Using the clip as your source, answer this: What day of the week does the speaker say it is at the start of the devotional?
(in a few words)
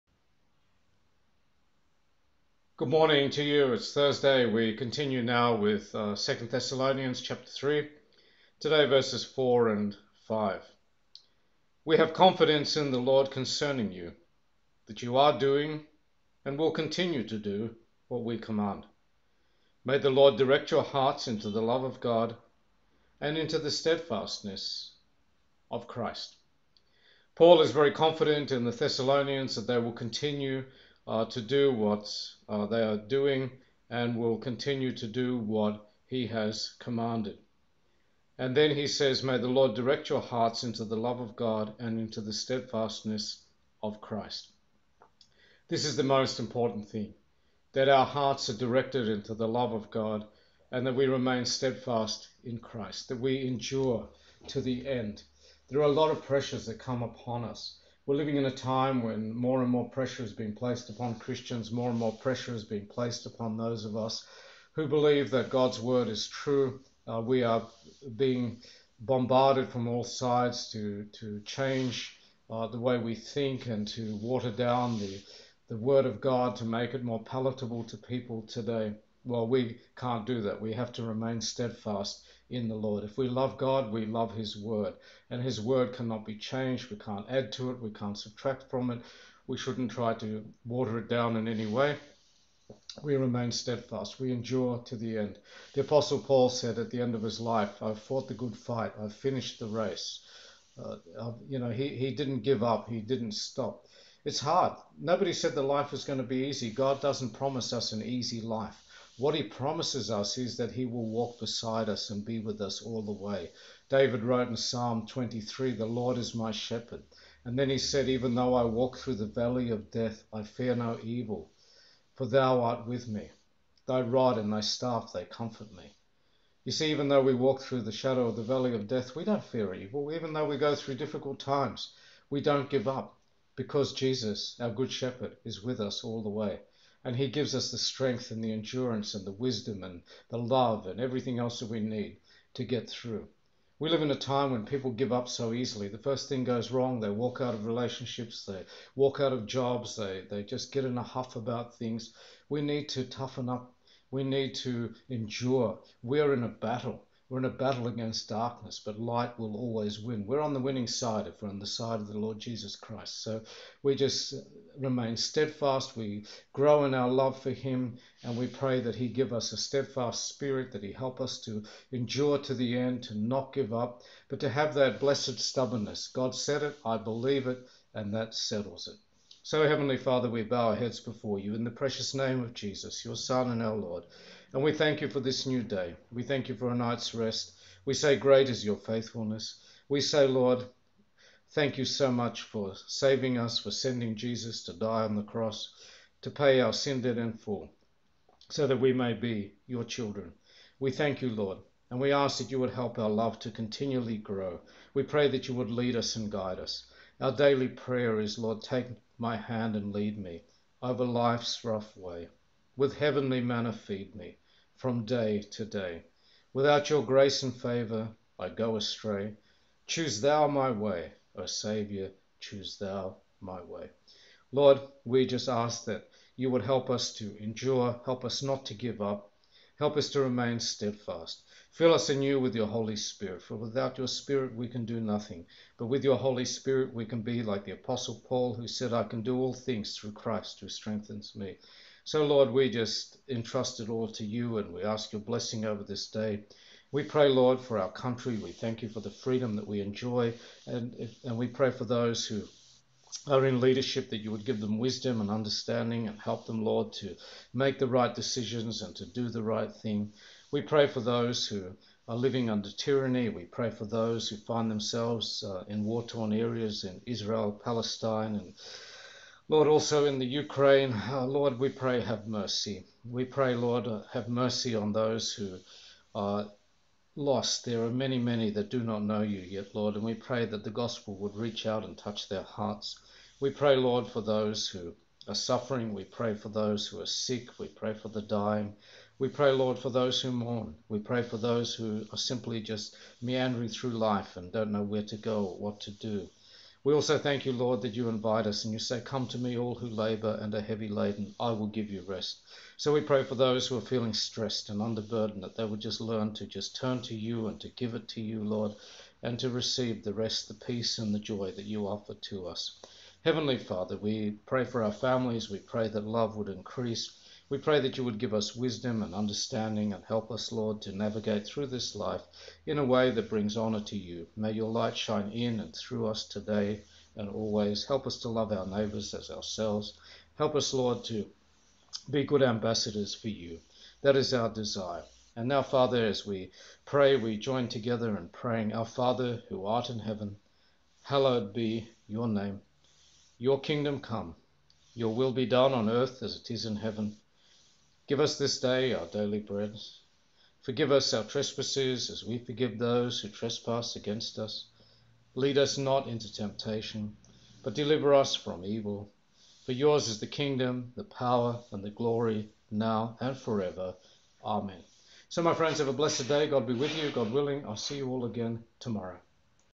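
Thursday.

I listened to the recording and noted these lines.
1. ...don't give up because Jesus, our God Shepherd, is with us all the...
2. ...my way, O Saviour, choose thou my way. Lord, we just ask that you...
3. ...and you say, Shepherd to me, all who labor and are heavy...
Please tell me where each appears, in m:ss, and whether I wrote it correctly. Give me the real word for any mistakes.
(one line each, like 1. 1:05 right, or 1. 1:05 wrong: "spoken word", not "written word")
1. 2:12 wrong: "Good", not "God"
2. 3:40 right
3. 4:58 wrong: "Come", not "Shepherd".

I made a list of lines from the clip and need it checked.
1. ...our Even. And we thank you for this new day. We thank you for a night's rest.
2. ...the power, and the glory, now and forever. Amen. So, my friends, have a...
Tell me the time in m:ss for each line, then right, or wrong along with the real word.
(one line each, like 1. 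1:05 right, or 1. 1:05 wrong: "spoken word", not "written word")
1. 3:03 wrong: "Lord", not "Even"
2. 6:00 right.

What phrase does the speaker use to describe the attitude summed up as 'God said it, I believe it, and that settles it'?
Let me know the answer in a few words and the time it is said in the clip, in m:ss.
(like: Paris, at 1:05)
blessed stubbornness, at 2:54.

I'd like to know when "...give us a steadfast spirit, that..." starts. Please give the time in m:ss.
2:49.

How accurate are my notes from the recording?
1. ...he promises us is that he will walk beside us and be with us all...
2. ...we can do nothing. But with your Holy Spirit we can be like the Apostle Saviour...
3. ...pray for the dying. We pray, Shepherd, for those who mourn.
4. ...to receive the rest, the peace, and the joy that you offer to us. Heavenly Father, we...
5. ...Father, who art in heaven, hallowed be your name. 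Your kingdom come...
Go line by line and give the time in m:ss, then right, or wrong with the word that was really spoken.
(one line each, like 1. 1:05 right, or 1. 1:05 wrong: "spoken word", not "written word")
1. 1:49 right
2. 3:54 wrong: "Paul", not "Saviour"
3. 4:47 wrong: "Lord", not "Shepherd"
4. 5:09 right
5. 5:38 right.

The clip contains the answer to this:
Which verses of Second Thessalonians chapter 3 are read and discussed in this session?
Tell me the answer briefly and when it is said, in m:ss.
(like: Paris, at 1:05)
4 and 5, at 0:08.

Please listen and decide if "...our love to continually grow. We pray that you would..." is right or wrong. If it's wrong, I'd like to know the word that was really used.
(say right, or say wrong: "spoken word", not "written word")
right.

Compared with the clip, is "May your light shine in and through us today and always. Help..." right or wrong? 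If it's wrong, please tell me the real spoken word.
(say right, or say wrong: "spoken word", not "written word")
right.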